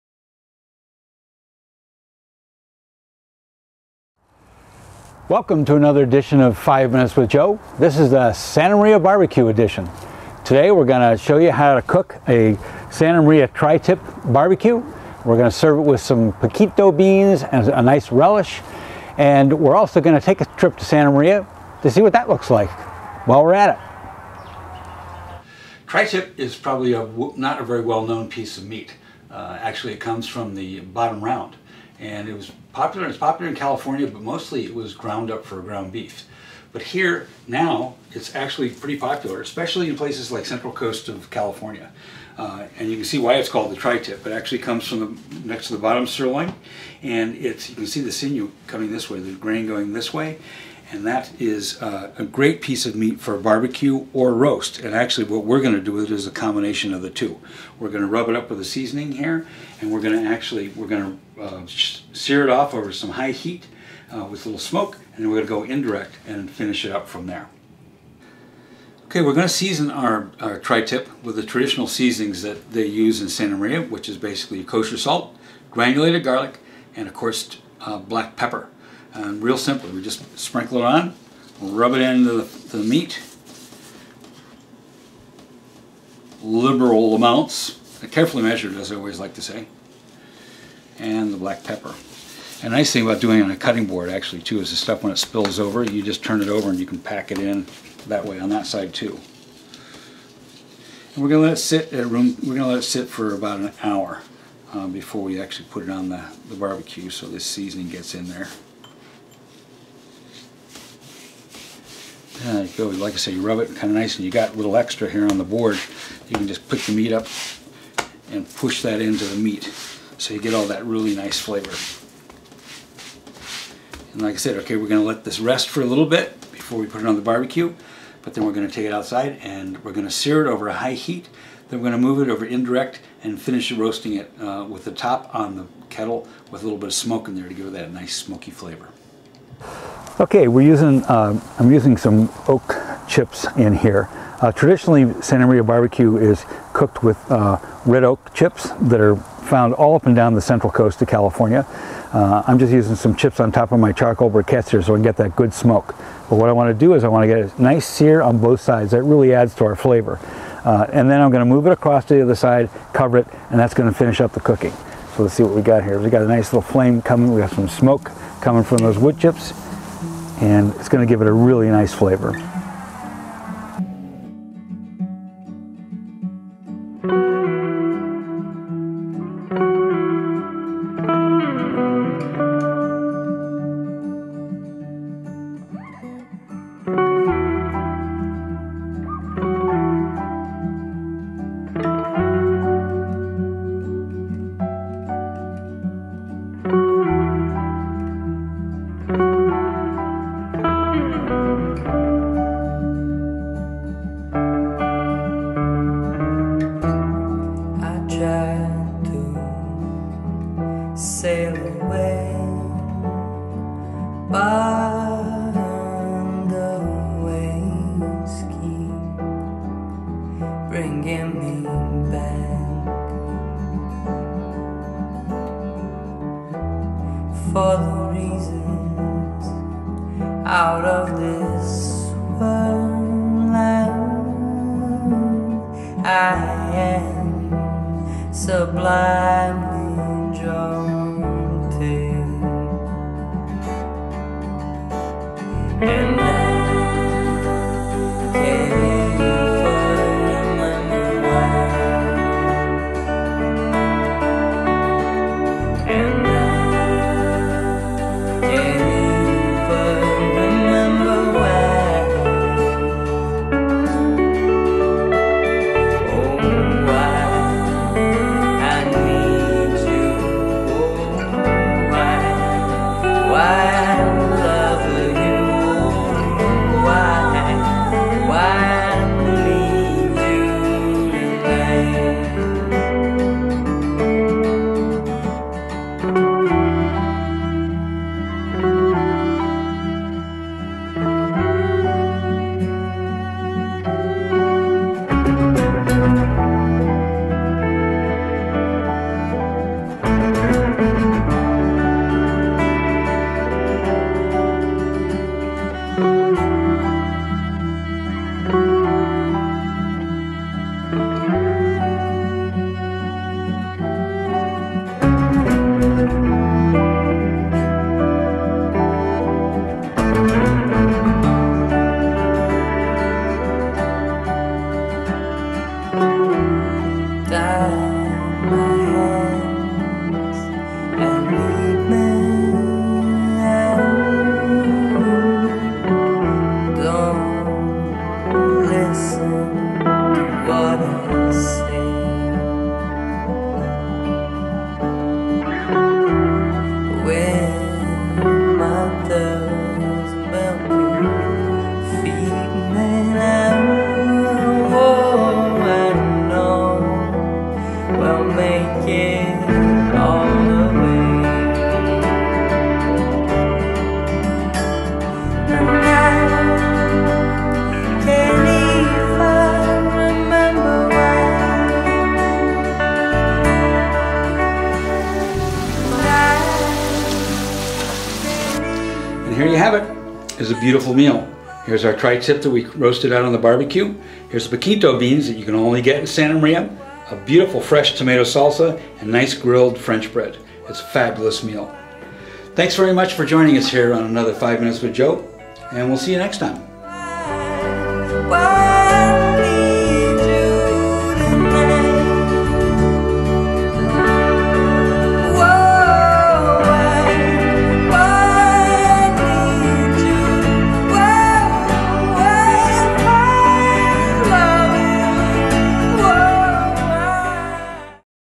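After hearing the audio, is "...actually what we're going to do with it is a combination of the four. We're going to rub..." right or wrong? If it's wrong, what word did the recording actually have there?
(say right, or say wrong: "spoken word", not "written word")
wrong: "two", not "four".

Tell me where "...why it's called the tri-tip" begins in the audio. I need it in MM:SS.
00:43.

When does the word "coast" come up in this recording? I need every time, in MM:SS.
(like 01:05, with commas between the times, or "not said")
00:40, 02:30.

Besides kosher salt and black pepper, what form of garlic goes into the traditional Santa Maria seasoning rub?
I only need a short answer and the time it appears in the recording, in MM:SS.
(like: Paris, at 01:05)
granulated garlic, at 01:15.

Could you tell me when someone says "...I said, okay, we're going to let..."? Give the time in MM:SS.
02:04.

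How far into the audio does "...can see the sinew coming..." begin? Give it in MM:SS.
00:47.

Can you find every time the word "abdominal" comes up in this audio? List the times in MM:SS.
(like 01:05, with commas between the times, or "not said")
not said.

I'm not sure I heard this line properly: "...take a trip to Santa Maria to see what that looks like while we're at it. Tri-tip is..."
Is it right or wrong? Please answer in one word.
right.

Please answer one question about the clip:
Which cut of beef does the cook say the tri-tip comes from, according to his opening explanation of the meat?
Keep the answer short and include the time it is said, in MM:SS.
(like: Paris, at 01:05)
bottom round, at 00:30.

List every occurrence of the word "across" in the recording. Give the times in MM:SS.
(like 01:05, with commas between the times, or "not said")
02:41.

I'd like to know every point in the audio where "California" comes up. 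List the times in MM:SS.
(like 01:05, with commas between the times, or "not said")
00:33, 00:41, 02:31.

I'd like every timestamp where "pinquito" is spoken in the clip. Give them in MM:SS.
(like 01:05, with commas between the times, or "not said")
00:16, 06:24.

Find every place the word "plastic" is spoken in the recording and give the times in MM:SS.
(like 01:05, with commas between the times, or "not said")
not said.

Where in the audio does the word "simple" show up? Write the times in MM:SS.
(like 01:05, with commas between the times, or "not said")
01:19.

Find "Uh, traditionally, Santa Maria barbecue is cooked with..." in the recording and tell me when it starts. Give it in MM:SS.
02:24.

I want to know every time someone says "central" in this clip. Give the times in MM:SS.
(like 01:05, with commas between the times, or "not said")
00:40, 02:30.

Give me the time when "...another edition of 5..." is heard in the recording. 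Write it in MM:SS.
00:05.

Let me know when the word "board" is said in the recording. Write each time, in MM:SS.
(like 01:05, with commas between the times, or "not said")
01:33, 01:55.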